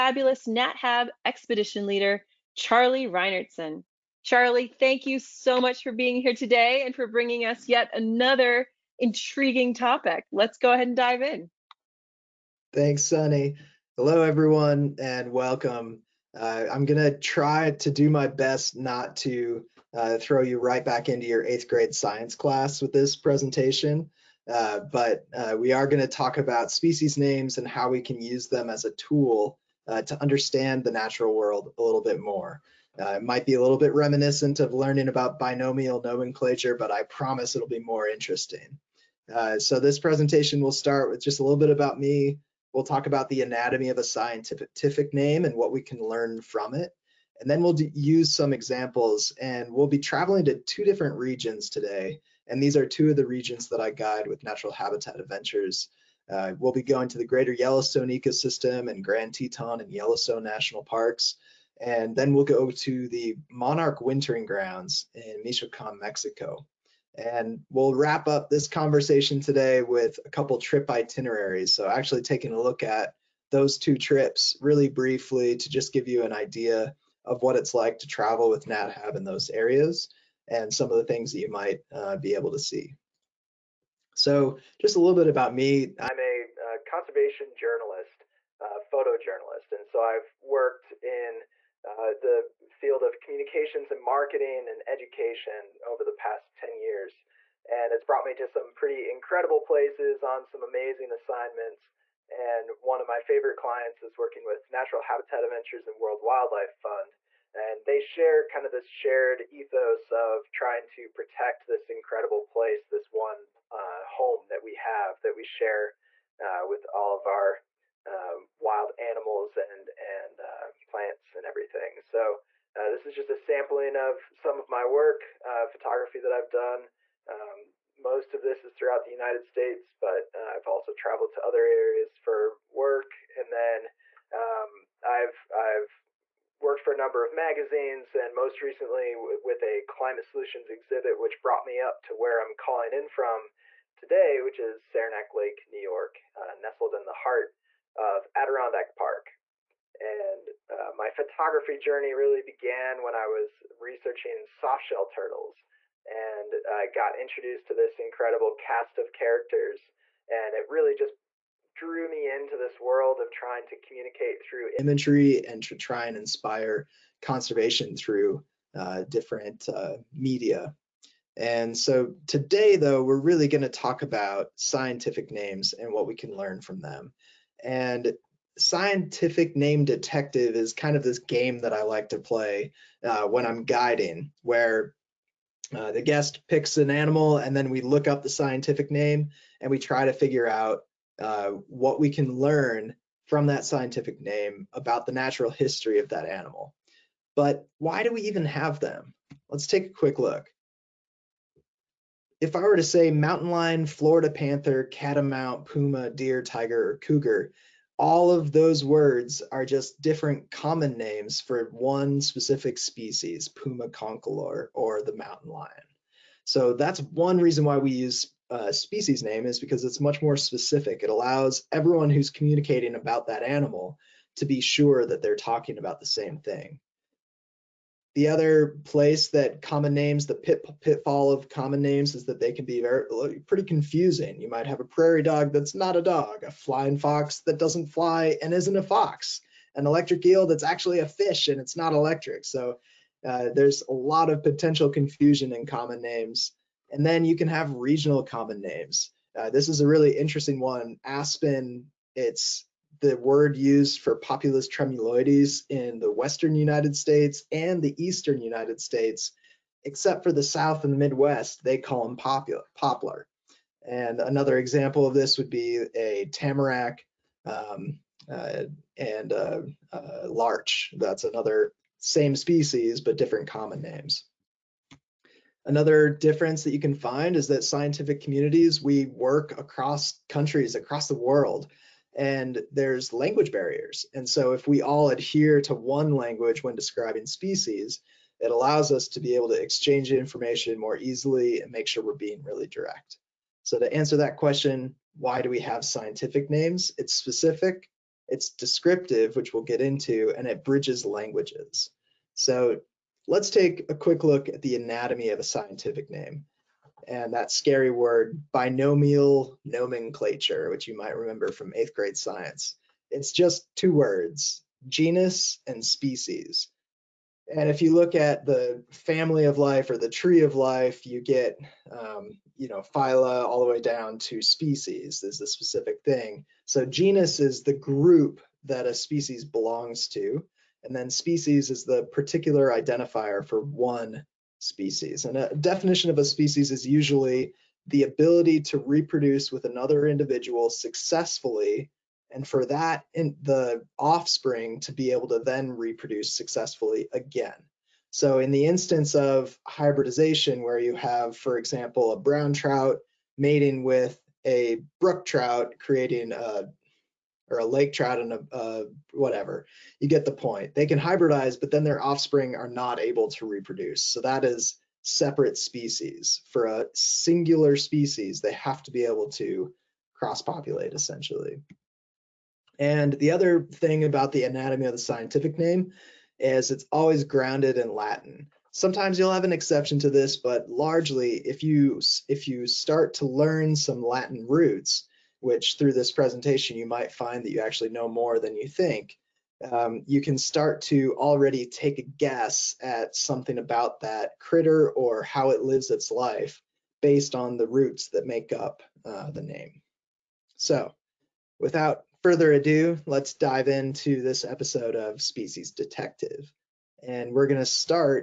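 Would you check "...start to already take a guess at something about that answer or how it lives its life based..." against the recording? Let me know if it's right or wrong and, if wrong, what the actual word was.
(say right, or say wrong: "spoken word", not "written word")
wrong: "critter", not "answer".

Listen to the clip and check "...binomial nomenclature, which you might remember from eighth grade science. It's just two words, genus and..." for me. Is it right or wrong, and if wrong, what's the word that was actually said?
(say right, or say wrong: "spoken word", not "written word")
right.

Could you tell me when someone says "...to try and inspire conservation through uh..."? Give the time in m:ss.
2:45.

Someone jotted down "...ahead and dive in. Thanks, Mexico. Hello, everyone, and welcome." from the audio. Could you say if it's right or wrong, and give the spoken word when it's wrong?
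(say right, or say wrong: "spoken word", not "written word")
wrong: "Sunny", not "Mexico".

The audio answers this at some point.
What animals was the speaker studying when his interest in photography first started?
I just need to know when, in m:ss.
2:34.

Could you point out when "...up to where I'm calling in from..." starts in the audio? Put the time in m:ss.
2:21.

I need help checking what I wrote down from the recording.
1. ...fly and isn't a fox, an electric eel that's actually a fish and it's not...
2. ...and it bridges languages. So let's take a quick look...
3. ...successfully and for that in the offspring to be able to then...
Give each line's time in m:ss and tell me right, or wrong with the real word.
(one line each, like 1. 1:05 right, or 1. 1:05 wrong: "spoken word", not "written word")
1. 3:57 right
2. 5:00 right
3. 5:40 right.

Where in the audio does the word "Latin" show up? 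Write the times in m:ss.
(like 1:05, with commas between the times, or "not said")
6:17, 6:24.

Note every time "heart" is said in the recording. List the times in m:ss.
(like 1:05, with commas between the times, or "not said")
2:27.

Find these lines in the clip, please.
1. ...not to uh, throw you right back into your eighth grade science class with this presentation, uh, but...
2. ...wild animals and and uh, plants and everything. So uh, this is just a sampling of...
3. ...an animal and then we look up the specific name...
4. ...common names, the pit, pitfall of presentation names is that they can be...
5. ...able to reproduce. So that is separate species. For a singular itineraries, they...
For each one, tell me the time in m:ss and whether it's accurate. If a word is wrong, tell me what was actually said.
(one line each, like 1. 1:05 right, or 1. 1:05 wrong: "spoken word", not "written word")
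1. 0:18 right
2. 1:58 right
3. 3:06 wrong: "scientific", not "specific"
4. 3:49 wrong: "common", not "presentation"
5. 6:02 wrong: "species", not "itineraries".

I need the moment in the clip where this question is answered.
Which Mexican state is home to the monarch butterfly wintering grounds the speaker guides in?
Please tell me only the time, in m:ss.
1:05.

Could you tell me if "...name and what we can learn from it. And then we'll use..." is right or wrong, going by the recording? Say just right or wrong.
right.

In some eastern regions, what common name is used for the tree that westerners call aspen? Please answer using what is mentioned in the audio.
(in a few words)
Poplar.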